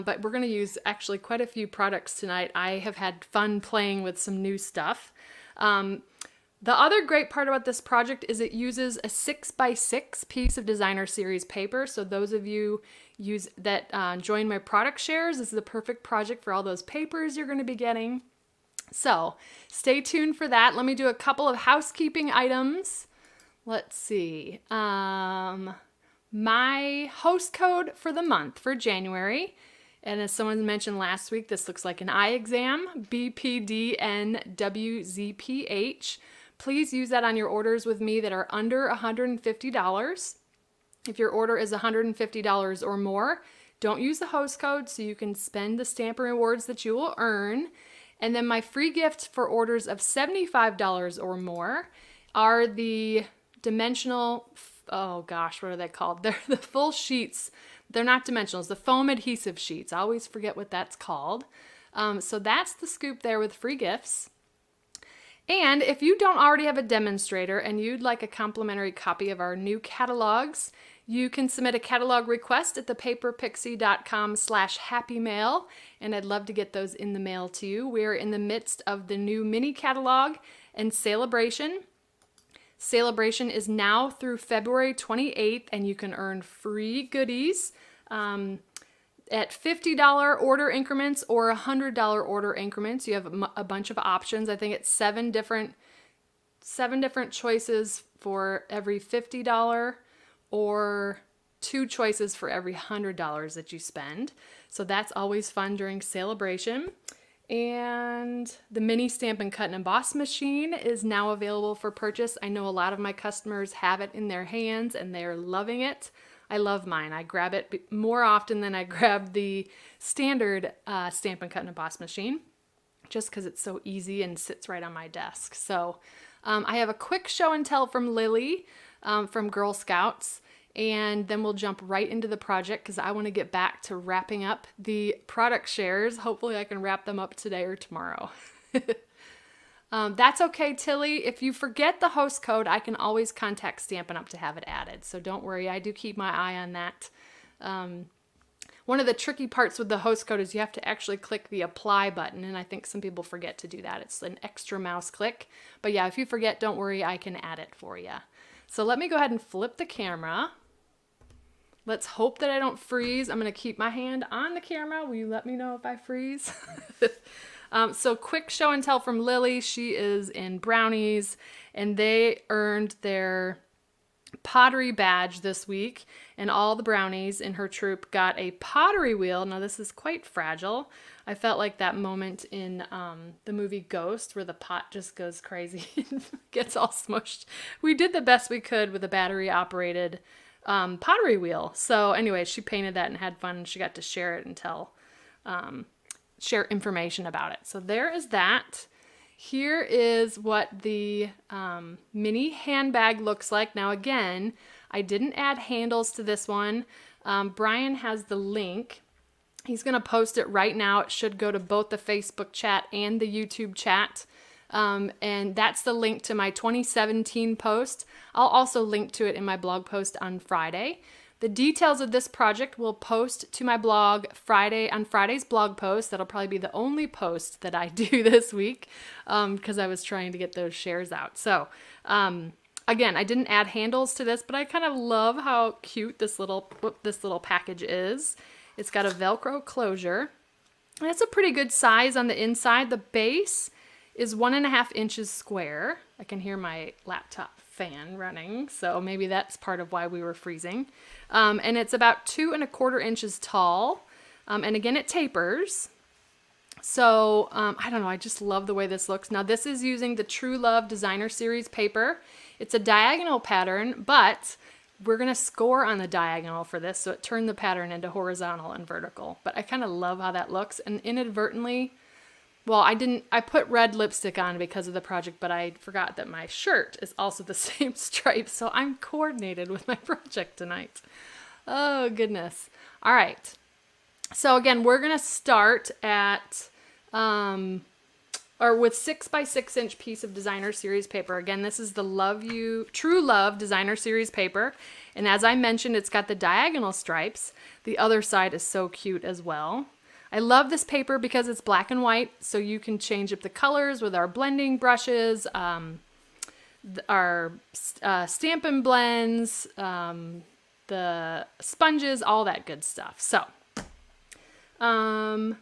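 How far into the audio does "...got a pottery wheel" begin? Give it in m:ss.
2:58.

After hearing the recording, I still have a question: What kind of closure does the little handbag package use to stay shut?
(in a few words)
Velcro.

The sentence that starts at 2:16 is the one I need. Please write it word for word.
Hopefully I can wrap them up today or tomorrow.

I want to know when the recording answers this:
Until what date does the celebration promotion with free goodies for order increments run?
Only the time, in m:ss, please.
1:24.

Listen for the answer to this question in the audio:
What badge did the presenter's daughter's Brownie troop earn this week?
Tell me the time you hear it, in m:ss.
2:54.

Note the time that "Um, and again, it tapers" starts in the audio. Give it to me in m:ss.
4:14.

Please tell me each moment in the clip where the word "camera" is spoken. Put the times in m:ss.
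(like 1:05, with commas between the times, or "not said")
2:39, 2:44.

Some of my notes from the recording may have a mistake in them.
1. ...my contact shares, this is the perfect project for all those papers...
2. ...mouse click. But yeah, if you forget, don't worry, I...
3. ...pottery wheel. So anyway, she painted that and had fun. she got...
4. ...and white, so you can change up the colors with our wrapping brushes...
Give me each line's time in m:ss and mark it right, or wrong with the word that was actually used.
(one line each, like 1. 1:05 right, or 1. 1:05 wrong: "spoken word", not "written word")
1. 0:14 wrong: "product", not "contact"
2. 2:34 right
3. 3:10 right
4. 5:01 wrong: "blending", not "wrapping".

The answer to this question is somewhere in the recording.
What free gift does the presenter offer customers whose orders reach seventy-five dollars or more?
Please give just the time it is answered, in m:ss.
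0:58.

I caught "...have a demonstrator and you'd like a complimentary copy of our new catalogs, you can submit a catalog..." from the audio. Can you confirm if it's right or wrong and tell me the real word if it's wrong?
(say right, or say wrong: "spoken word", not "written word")
right.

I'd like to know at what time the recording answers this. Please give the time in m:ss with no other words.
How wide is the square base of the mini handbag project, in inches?
4:04.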